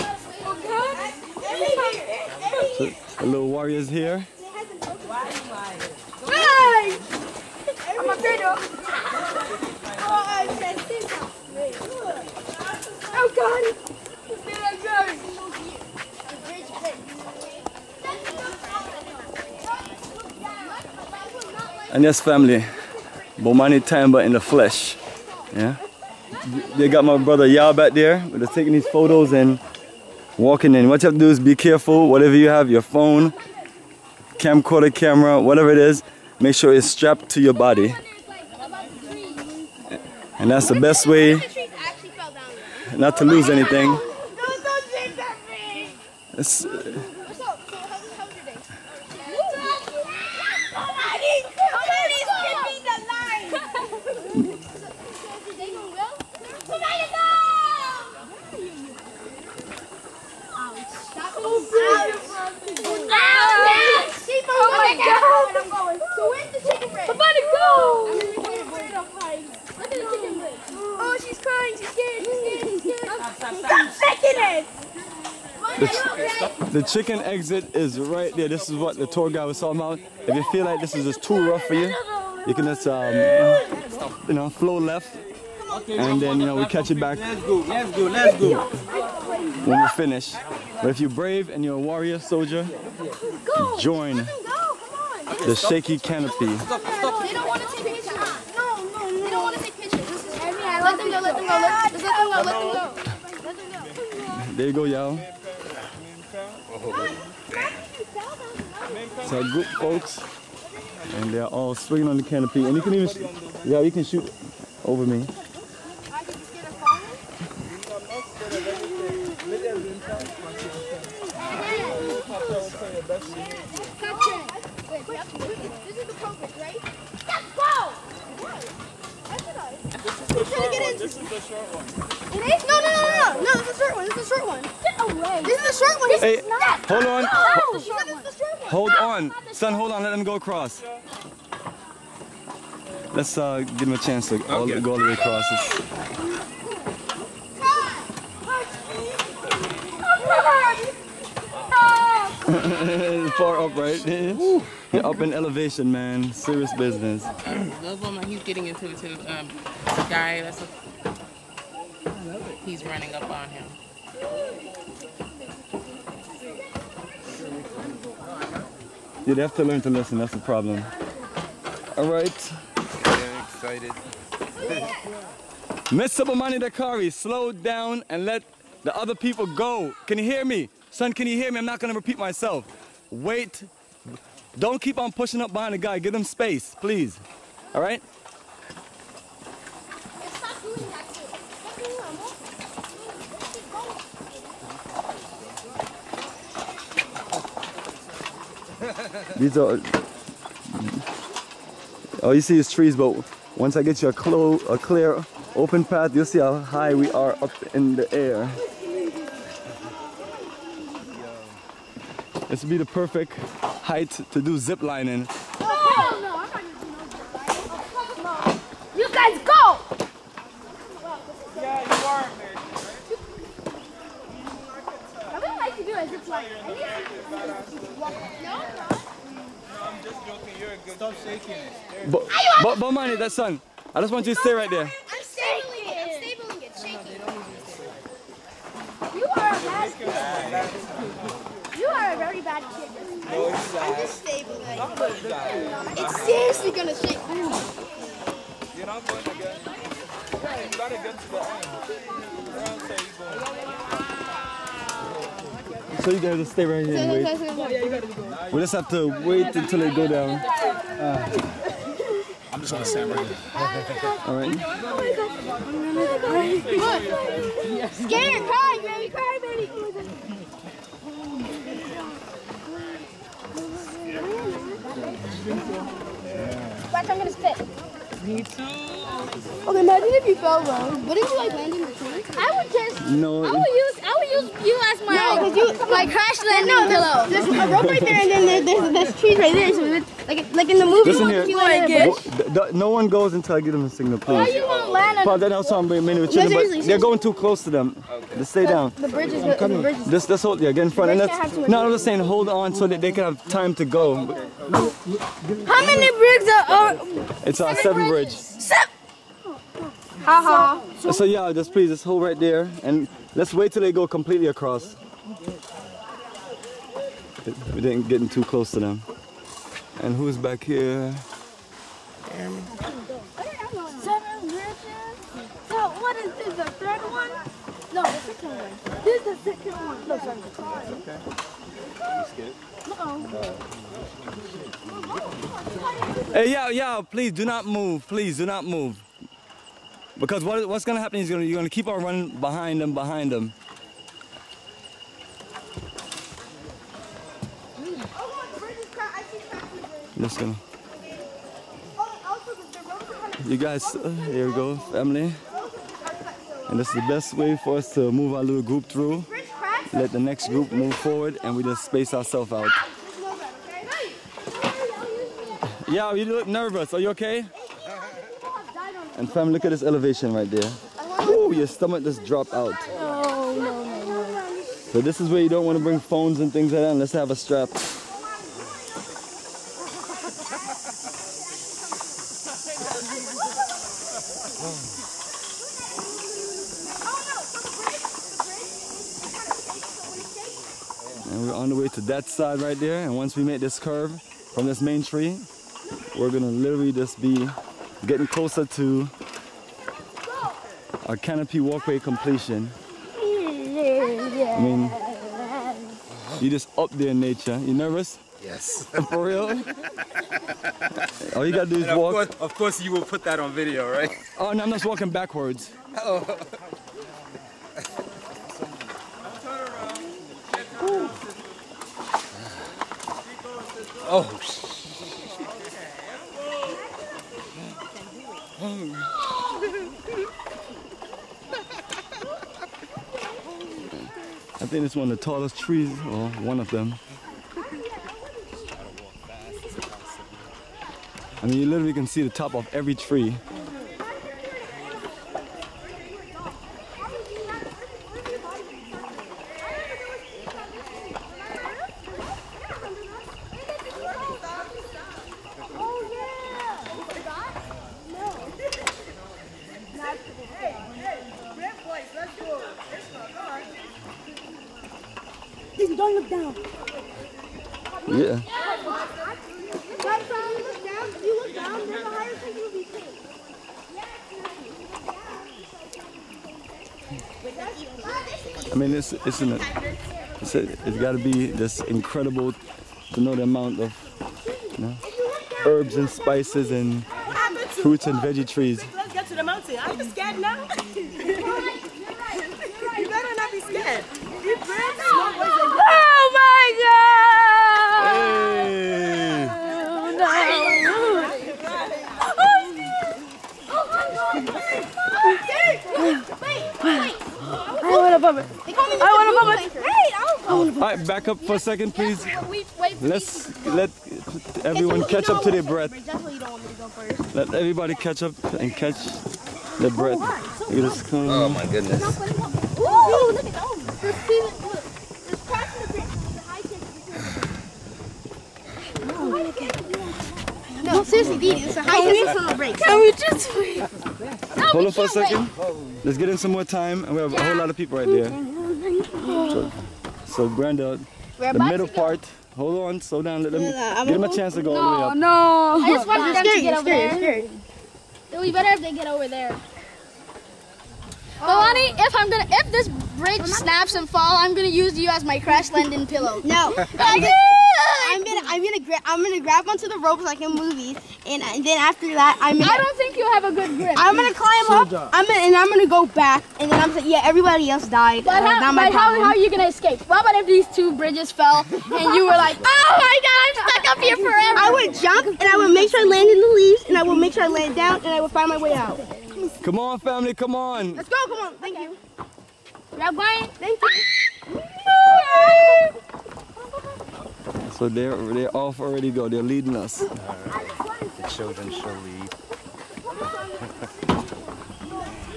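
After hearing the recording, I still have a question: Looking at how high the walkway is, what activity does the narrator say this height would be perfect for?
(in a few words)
Zip lining.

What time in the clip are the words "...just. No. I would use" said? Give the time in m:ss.
4:42.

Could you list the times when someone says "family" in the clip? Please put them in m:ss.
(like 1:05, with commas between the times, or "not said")
0:22, 5:54, 9:39.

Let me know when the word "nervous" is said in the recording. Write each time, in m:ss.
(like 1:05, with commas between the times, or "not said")
6:06, 6:47.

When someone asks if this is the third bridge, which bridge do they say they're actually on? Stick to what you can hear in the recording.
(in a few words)
The second one.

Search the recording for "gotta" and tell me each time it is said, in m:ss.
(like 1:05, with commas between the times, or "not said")
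4:10, 6:51.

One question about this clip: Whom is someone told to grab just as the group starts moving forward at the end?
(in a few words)
Brian.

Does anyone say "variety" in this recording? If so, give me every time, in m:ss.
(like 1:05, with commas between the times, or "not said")
not said.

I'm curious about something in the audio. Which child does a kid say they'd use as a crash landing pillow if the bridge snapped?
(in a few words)
Kalani.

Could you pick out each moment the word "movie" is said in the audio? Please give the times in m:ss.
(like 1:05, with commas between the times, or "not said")
4:50, 9:20.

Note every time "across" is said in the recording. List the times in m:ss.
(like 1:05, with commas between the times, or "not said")
2:20, 2:25, 5:14.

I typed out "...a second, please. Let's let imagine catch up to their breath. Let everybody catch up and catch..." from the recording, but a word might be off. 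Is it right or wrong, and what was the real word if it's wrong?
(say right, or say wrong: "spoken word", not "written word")
wrong: "everyone", not "imagine".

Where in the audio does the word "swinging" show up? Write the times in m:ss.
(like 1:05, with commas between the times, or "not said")
1:51.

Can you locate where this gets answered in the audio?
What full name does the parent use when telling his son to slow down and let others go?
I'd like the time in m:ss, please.
2:56.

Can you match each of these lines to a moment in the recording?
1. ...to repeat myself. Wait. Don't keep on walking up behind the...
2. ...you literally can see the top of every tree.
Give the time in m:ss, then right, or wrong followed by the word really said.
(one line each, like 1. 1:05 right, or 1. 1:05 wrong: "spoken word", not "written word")
1. 3:01 wrong: "pushing", not "walking"
2. 7:21 right.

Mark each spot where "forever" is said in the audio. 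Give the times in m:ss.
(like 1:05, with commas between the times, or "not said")
9:34.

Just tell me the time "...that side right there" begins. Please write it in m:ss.
6:32.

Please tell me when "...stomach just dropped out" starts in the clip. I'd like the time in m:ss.
6:11.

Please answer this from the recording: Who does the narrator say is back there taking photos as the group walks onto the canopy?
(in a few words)
Yao.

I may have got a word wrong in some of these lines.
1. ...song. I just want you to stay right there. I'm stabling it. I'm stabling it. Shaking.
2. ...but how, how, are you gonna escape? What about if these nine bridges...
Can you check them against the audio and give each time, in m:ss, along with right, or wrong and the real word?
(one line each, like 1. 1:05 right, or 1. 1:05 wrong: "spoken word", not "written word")
1. 3:53 right
2. 9:28 wrong: "two", not "nine".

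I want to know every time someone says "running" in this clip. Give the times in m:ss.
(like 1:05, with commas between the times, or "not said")
2:42, 5:42.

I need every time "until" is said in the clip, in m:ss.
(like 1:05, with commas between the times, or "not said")
4:19, 4:53.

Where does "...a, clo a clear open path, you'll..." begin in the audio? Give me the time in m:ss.
3:24.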